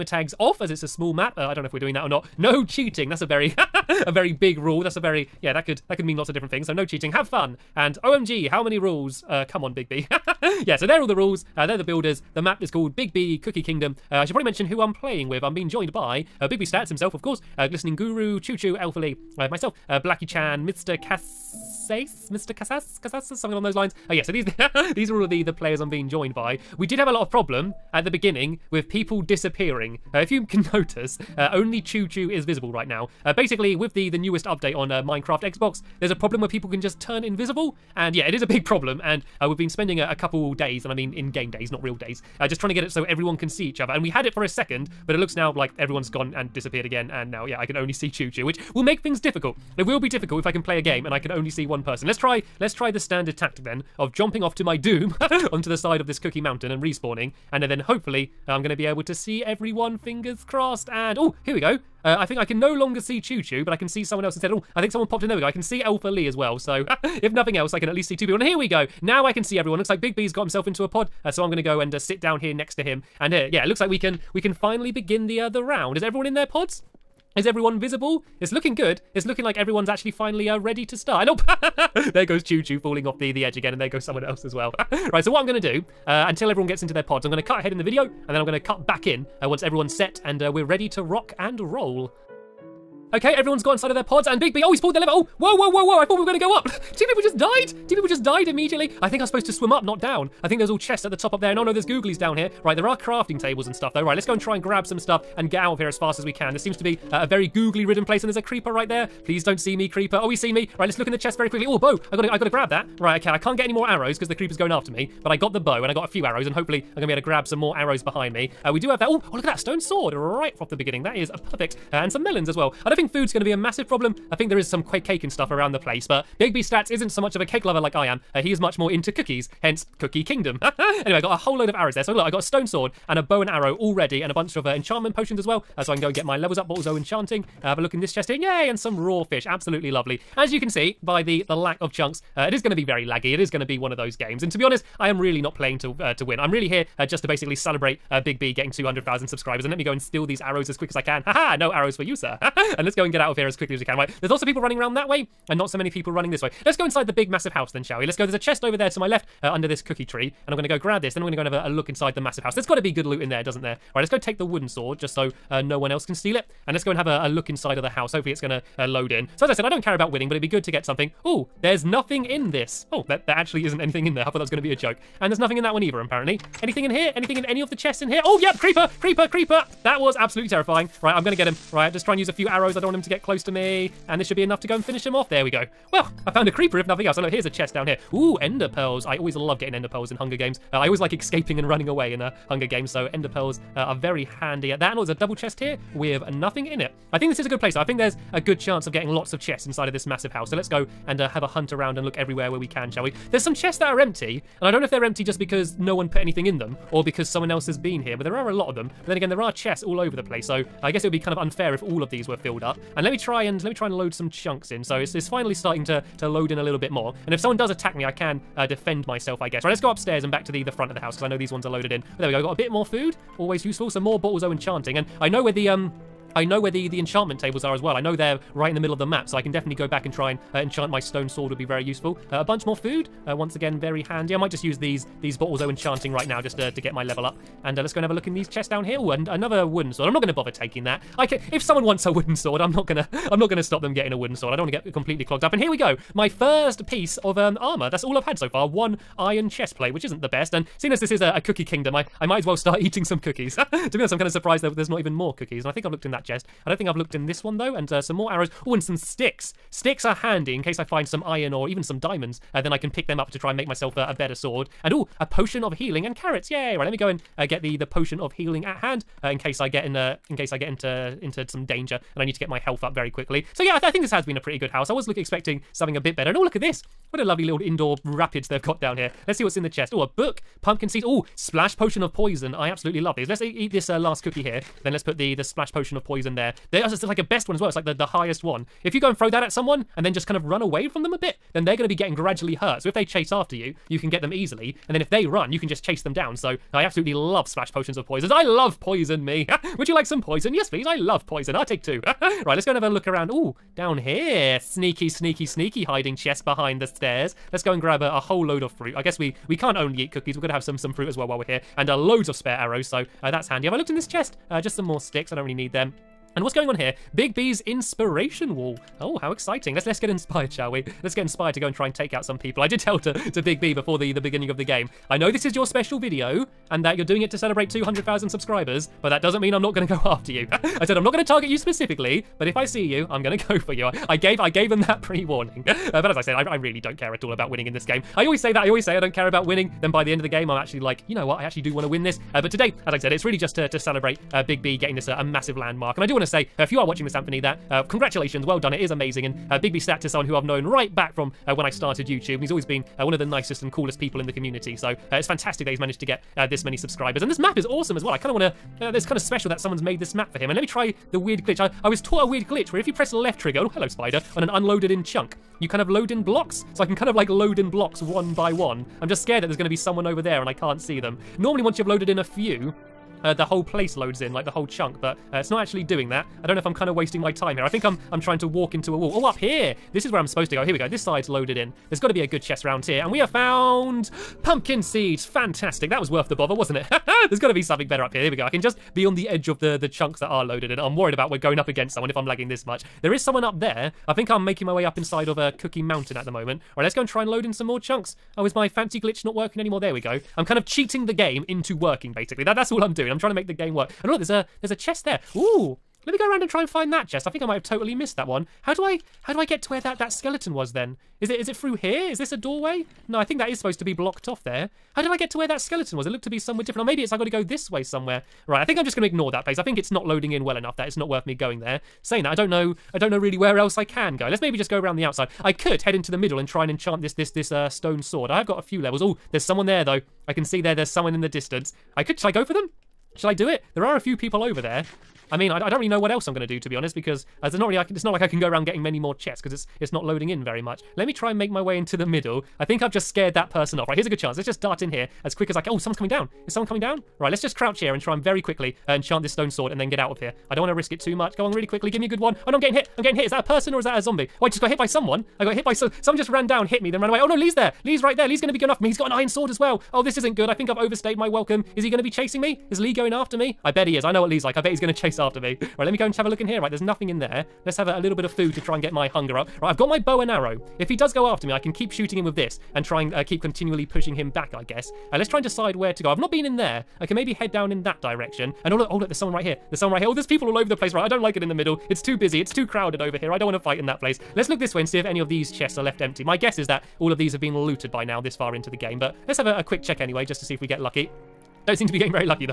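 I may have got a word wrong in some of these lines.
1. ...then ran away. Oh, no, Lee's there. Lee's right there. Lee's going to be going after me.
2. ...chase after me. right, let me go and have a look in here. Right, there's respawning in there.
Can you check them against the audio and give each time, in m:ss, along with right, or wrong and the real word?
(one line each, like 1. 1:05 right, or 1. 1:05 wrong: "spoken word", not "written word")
1. 7:36 right
2. 7:44 wrong: "nothing", not "respawning".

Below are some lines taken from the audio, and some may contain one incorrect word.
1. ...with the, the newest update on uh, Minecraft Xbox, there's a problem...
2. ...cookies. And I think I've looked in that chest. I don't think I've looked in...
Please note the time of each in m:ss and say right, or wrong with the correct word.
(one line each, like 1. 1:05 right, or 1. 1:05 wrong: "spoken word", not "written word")
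1. 0:33 right
2. 4:15 right.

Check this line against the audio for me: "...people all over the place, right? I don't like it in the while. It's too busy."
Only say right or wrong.
wrong.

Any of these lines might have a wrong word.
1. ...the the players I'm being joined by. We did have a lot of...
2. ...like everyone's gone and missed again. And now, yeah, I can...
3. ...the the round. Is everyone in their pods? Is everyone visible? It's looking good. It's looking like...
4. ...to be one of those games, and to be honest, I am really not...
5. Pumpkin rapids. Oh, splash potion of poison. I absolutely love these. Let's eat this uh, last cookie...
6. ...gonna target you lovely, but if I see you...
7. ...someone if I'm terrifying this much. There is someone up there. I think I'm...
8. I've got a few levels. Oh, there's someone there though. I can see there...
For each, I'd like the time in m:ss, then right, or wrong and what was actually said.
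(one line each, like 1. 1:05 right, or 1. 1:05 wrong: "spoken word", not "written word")
1. 0:25 right
2. 0:45 wrong: "disappeared", not "missed"
3. 1:15 right
4. 2:23 right
5. 4:40 wrong: "seeds", not "rapids"
6. 5:31 wrong: "specifically", not "lovely"
7. 6:31 wrong: "lagging", not "terrifying"
8. 7:08 right.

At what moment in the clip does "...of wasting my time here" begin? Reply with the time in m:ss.
6:16.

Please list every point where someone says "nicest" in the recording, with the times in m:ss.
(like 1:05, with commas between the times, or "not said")
5:53.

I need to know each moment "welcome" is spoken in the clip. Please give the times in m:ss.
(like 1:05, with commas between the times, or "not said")
7:41.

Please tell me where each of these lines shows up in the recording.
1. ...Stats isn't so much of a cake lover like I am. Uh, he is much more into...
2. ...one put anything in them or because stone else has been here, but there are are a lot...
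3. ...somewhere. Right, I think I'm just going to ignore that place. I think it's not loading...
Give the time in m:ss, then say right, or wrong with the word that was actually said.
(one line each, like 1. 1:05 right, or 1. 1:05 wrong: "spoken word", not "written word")
1. 2:06 right
2. 3:25 wrong: "someone", not "stone"
3. 6:57 right.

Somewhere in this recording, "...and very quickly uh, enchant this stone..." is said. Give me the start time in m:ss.
7:28.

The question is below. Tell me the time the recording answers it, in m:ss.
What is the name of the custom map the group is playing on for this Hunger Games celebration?
0:12.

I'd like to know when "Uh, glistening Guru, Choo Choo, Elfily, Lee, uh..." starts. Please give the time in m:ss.
0:17.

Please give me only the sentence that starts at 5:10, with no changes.
We're going to have some, some fruit as well while we're here.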